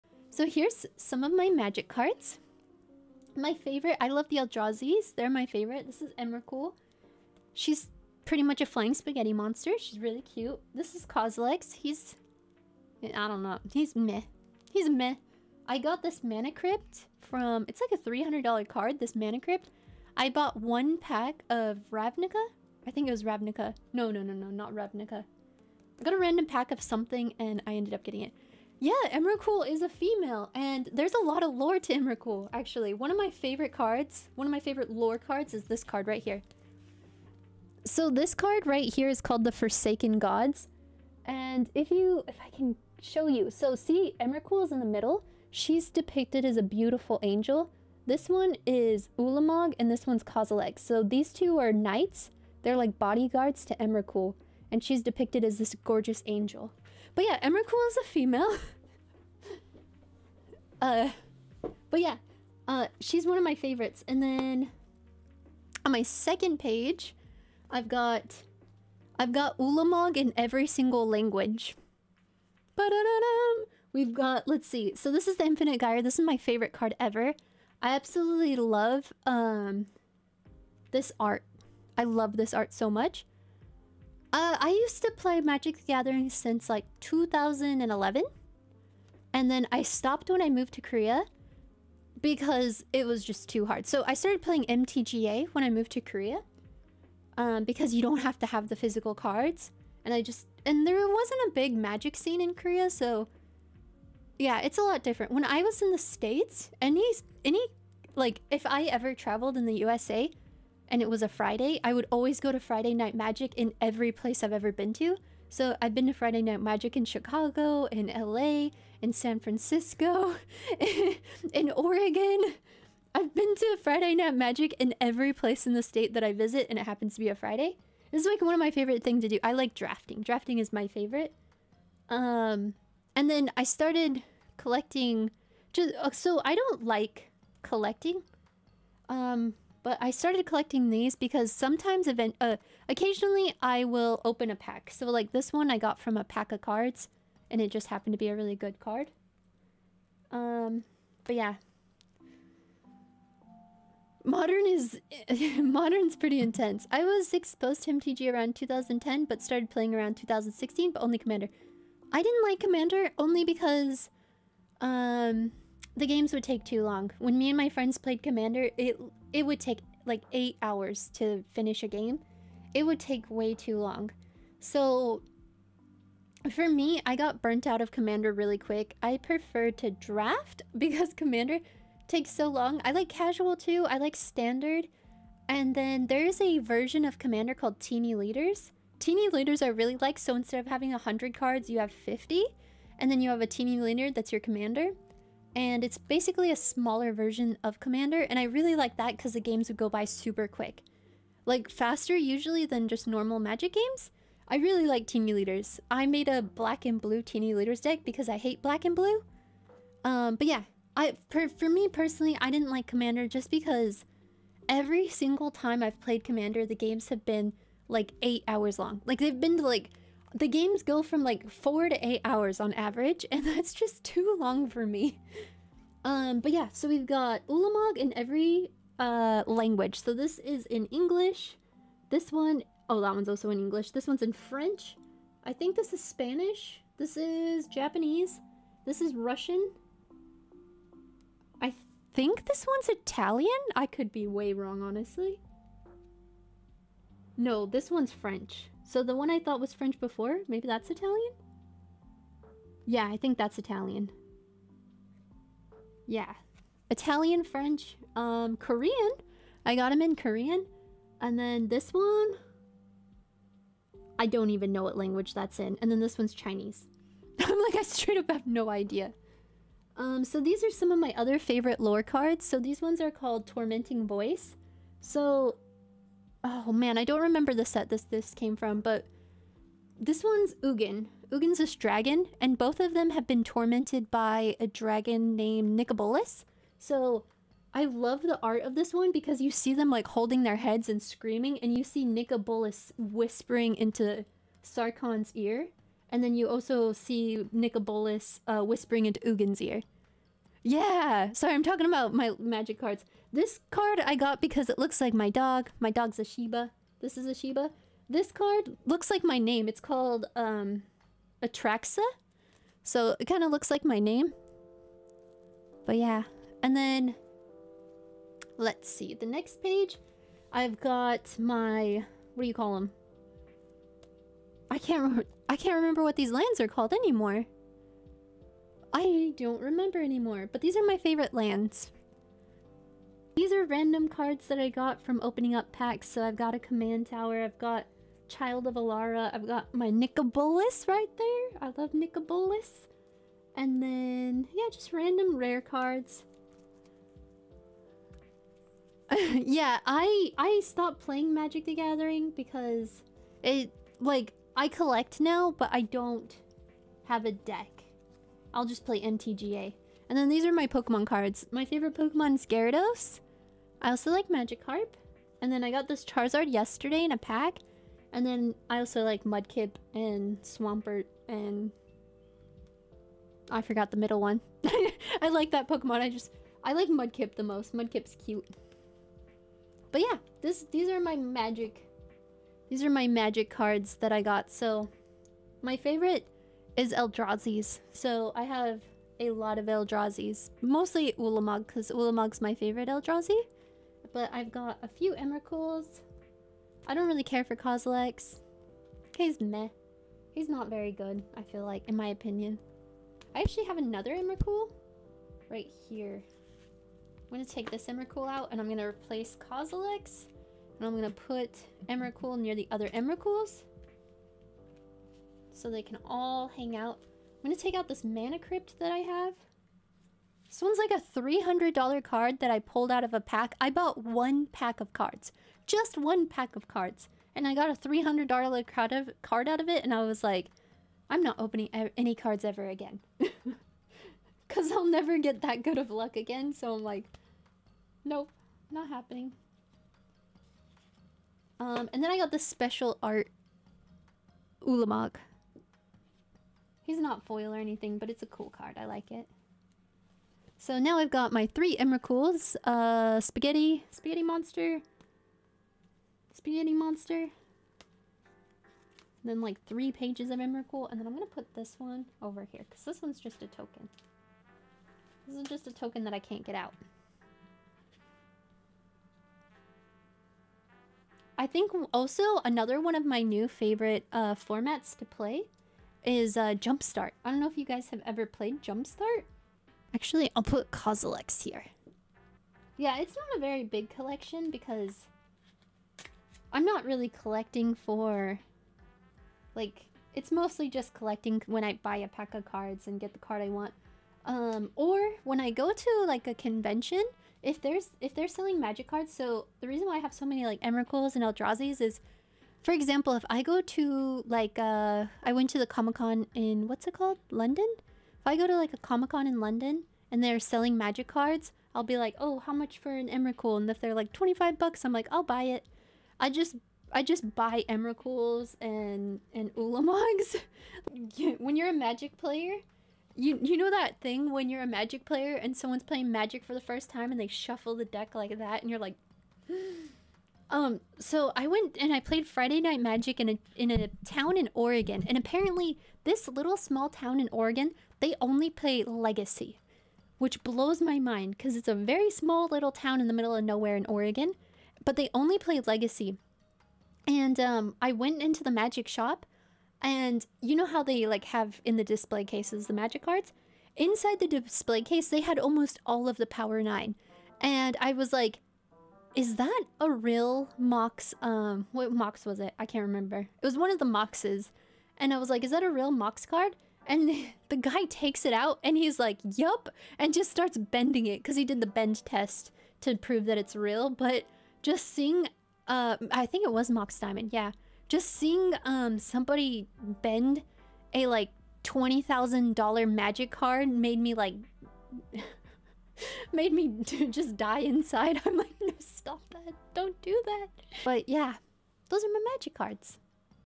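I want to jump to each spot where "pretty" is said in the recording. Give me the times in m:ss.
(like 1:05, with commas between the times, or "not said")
0:08, 2:36.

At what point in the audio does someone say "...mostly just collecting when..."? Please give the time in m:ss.
8:10.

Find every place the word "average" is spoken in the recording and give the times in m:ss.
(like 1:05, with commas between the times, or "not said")
3:42.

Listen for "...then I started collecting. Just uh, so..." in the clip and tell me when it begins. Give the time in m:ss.
2:13.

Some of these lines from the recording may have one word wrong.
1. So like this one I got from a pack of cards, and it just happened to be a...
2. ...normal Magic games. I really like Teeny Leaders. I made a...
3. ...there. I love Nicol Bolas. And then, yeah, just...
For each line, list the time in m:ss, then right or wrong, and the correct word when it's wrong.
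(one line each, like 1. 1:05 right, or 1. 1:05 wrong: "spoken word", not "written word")
1. 2:24 right
2. 3:23 right
3. 5:41 right.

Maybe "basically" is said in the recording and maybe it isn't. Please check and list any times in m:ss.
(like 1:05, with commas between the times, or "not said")
3:15.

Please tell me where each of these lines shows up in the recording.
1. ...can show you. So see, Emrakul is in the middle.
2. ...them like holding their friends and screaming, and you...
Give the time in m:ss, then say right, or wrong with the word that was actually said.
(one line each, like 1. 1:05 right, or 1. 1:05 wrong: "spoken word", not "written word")
1. 0:42 right
2. 4:49 wrong: "heads", not "friends".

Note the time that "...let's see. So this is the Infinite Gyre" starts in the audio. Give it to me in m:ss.
1:14.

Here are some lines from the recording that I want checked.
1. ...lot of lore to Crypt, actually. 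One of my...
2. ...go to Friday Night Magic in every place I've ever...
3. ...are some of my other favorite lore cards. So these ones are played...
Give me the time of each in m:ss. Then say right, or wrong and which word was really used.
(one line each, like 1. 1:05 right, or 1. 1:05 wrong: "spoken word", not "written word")
1. 0:31 wrong: "Emrakul", not "Crypt"
2. 1:52 right
3. 4:30 wrong: "called", not "played".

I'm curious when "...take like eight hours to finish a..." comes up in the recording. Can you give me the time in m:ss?
2:49.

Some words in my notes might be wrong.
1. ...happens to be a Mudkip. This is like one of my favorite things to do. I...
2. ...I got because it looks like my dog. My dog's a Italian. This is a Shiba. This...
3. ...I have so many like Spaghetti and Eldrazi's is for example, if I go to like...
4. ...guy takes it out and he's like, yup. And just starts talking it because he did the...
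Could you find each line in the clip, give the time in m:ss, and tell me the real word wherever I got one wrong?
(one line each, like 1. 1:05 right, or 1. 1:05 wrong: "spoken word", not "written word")
1. 2:06 wrong: "Friday", not "Mudkip"
2. 5:04 wrong: "Shiba", not "Italian"
3. 8:19 wrong: "Emrakuls", not "Spaghetti"
4. 9:27 wrong: "bending", not "talking".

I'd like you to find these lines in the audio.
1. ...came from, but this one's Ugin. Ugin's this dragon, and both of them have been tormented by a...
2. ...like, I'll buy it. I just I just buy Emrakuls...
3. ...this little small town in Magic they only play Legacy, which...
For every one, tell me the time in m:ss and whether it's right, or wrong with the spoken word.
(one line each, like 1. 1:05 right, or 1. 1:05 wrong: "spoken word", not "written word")
1. 4:38 right
2. 8:34 right
3. 8:56 wrong: "Oregon", not "Magic".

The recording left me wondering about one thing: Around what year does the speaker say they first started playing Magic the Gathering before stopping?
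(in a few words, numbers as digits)
2011.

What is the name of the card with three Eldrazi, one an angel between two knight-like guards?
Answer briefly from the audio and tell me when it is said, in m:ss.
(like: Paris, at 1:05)
The Forsaken Gods, at 0:39.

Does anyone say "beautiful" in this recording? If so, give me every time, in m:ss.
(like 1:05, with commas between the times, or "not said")
0:46.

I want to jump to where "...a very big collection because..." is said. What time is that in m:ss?
8:03.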